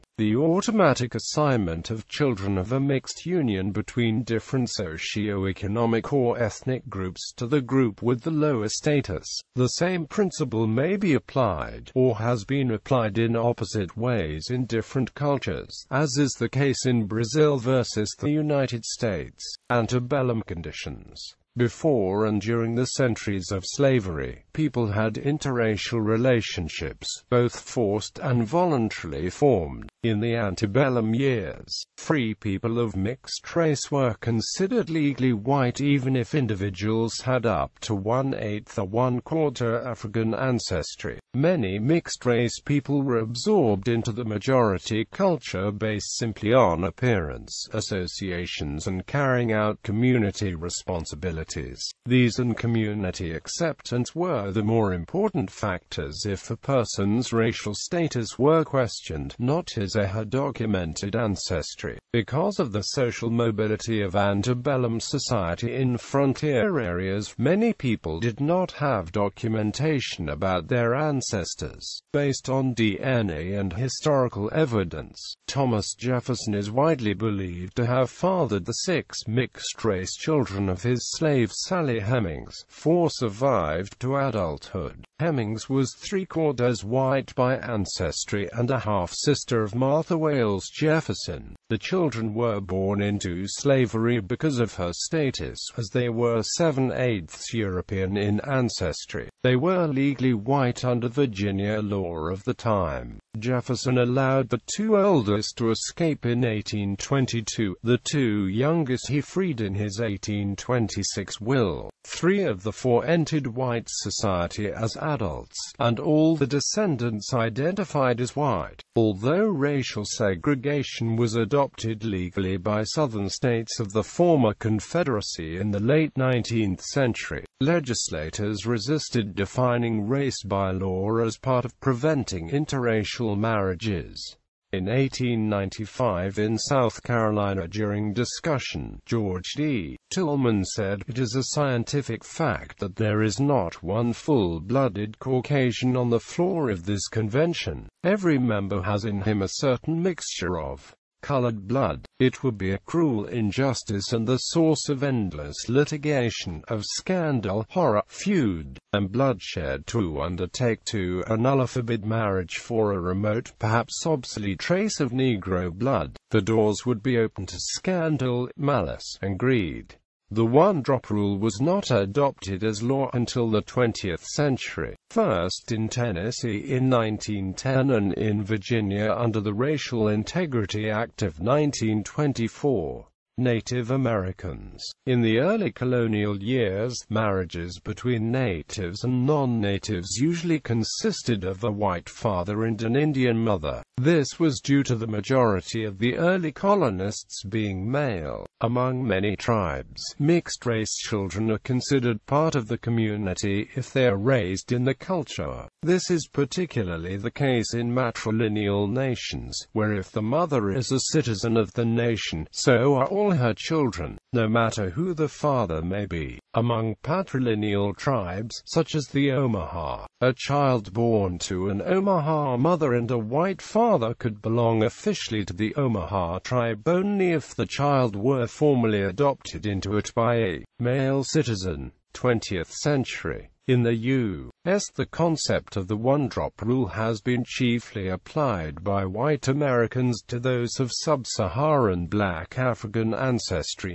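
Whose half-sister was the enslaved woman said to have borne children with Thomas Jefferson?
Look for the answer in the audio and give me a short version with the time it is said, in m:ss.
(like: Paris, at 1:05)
Martha Wayles Jefferson, at 1:29.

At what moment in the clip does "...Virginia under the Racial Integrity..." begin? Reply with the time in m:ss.
2:58.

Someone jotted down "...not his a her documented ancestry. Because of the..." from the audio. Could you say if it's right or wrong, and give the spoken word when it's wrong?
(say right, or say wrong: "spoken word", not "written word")
right.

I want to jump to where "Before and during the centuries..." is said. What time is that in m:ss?
0:21.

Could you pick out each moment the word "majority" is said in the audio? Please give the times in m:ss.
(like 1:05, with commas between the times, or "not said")
0:44, 3:15.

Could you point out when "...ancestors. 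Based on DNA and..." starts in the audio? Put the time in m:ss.
1:10.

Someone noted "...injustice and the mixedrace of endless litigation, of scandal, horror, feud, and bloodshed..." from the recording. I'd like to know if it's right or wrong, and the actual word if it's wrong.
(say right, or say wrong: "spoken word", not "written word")
wrong: "source", not "mixedrace".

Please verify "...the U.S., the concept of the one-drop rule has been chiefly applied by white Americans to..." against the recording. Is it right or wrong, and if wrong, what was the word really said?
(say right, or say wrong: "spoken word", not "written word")
right.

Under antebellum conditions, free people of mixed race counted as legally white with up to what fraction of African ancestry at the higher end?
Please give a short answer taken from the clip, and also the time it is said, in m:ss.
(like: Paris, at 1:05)
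one-quarter, at 0:38.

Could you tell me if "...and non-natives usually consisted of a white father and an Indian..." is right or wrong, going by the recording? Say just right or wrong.
right.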